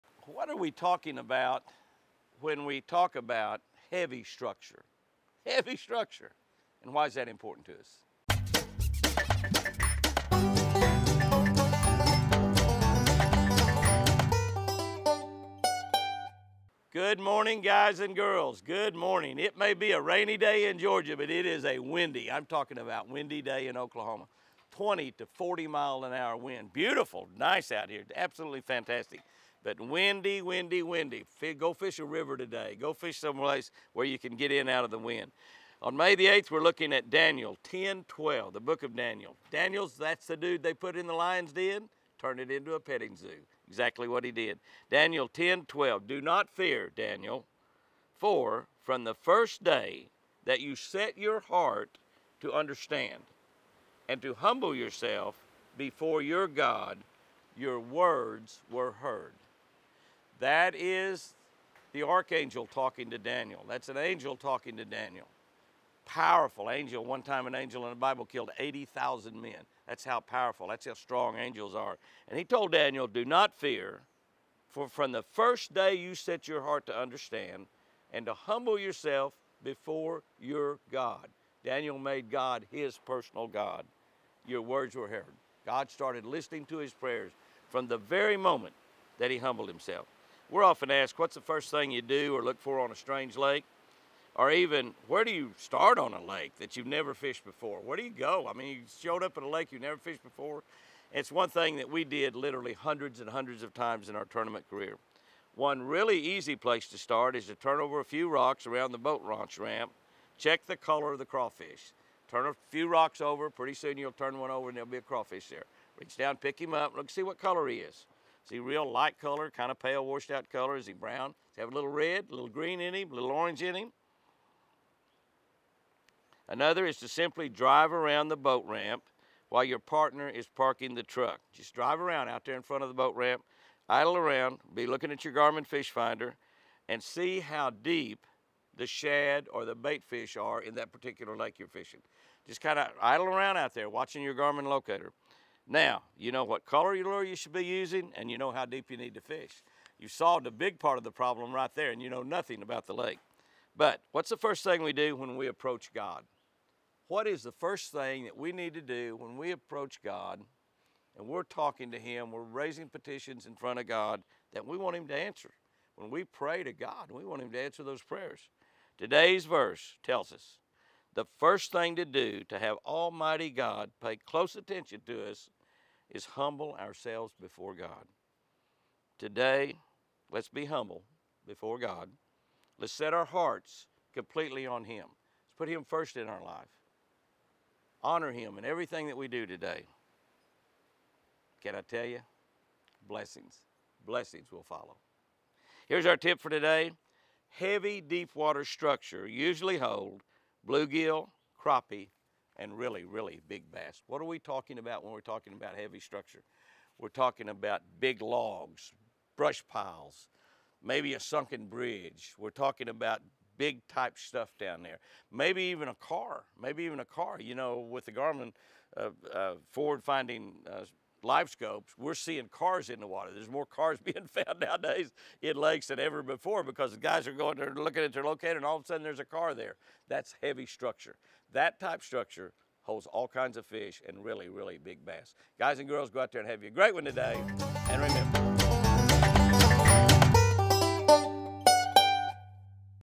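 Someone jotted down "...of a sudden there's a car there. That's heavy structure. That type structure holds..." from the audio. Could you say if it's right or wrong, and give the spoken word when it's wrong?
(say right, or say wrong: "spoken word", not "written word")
right.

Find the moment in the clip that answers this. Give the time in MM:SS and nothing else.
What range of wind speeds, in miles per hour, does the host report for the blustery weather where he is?
00:24.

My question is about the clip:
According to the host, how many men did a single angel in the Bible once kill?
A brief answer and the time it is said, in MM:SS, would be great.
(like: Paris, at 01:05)
80,000, at 01:08.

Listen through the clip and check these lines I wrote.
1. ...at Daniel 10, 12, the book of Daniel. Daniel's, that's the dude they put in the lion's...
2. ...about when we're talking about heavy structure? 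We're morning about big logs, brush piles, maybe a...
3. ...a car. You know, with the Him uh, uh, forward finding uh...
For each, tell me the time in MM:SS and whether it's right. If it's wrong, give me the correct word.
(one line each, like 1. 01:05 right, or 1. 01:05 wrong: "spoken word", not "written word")
1. 00:36 right
2. 03:24 wrong: "talking", not "morning"
3. 03:36 wrong: "Garmin", not "Him".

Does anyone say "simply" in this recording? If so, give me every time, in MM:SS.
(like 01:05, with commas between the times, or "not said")
02:07.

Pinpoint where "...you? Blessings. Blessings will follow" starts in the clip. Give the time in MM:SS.
03:12.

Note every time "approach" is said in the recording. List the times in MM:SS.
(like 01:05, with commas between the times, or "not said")
02:35, 02:39.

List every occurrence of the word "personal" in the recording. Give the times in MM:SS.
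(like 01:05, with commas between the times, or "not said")
01:22.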